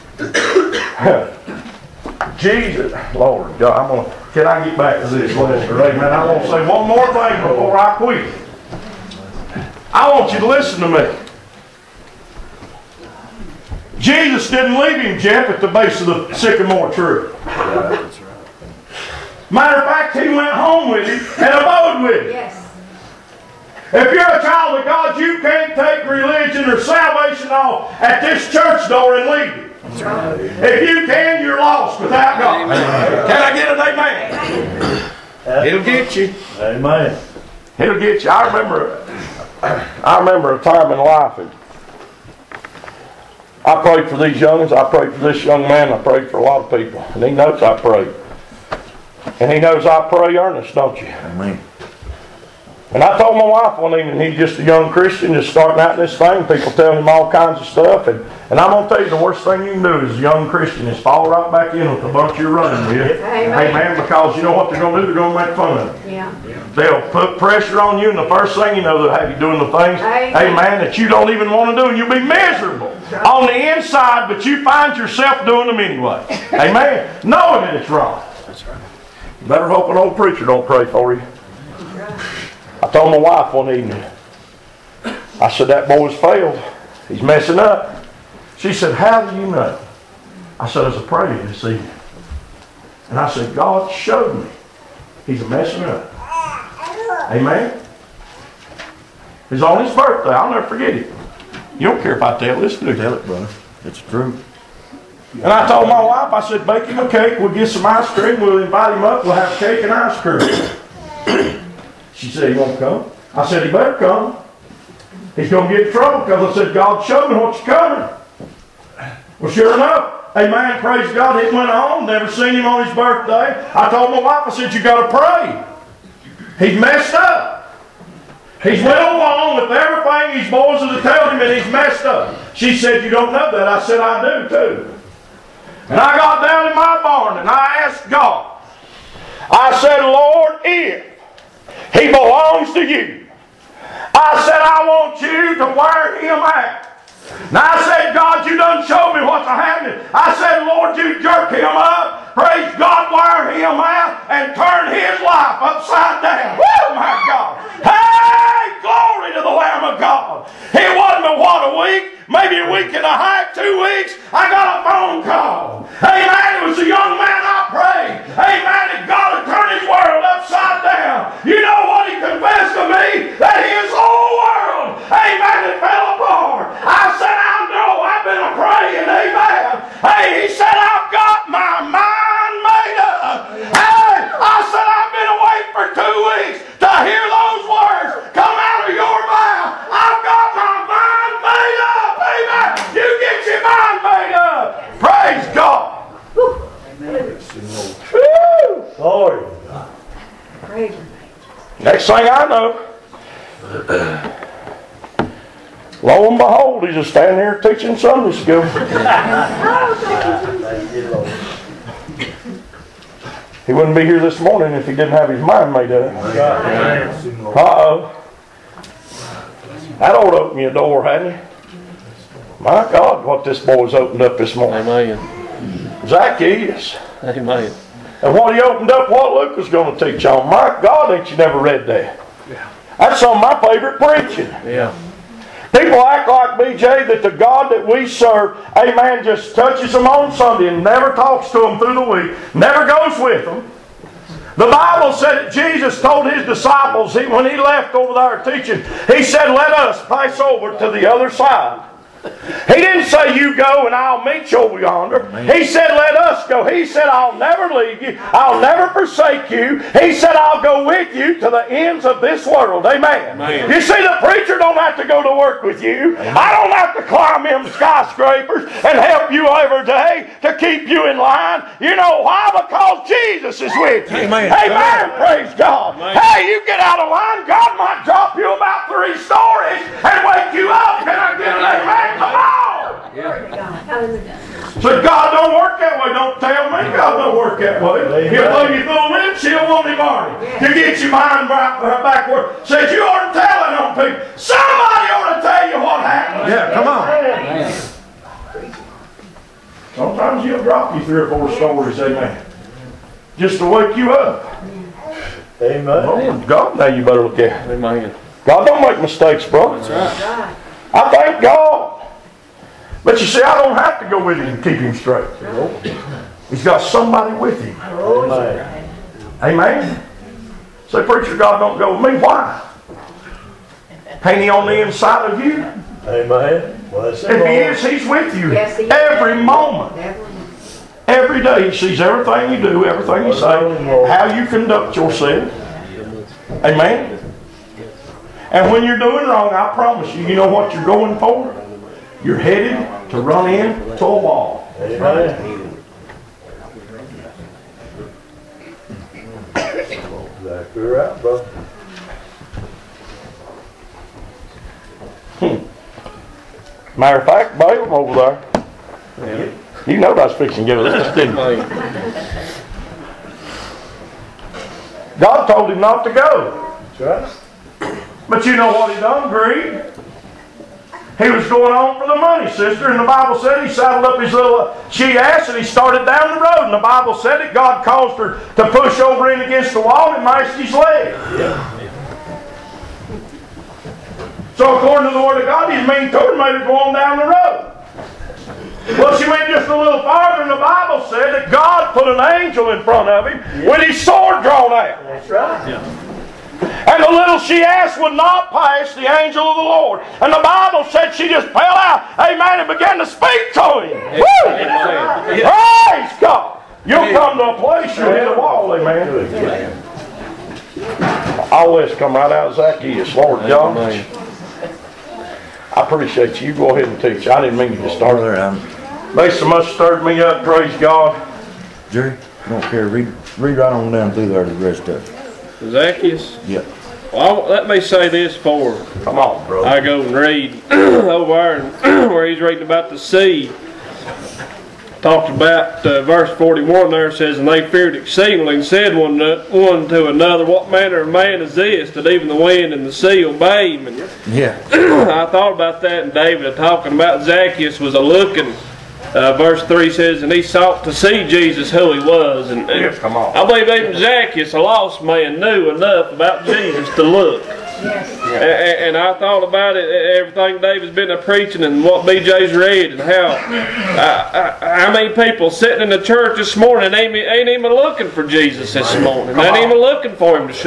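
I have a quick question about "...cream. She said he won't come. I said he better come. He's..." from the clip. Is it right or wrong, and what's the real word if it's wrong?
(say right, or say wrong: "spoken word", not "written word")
right.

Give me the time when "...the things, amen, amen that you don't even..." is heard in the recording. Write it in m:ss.
1:09.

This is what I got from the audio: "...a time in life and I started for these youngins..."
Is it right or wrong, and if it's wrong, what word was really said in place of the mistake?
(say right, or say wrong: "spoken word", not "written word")
wrong: "prayed", not "started".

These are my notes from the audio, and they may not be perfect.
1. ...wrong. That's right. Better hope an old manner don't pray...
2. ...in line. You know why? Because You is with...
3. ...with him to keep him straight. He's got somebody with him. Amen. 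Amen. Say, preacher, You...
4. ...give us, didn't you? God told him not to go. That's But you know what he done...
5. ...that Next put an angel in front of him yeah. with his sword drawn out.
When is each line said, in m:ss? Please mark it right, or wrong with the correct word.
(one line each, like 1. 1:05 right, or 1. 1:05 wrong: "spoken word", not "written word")
1. 1:17 wrong: "preacher", not "manner"
2. 4:31 wrong: "Jesus", not "You"
3. 5:14 wrong: "God", not "You"
4. 6:00 right
5. 6:31 wrong: "God", not "Next".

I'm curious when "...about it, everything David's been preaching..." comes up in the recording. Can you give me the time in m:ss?
7:39.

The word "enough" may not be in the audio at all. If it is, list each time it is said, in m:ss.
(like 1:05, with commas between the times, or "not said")
1:59, 7:35.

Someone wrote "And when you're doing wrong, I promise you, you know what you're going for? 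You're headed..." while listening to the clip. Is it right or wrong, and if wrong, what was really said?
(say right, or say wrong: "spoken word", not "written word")
right.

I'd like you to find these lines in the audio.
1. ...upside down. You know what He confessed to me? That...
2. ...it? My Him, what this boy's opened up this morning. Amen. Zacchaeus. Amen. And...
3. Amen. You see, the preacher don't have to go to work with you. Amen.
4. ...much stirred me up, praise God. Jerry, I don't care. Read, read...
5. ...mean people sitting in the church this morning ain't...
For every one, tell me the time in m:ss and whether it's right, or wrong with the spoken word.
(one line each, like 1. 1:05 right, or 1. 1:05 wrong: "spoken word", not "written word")
1. 2:50 right
2. 3:41 wrong: "God", not "Him"
3. 4:23 right
4. 6:59 right
5. 7:44 right.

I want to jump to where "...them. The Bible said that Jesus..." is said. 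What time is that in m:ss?
4:03.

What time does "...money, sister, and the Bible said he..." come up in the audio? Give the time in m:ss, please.
6:12.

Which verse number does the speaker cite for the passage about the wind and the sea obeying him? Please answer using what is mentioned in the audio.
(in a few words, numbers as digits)
41.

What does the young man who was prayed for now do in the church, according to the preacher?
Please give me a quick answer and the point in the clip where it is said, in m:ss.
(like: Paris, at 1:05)
Teaching Sunday school, at 3:27.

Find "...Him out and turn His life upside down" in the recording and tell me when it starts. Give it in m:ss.
2:33.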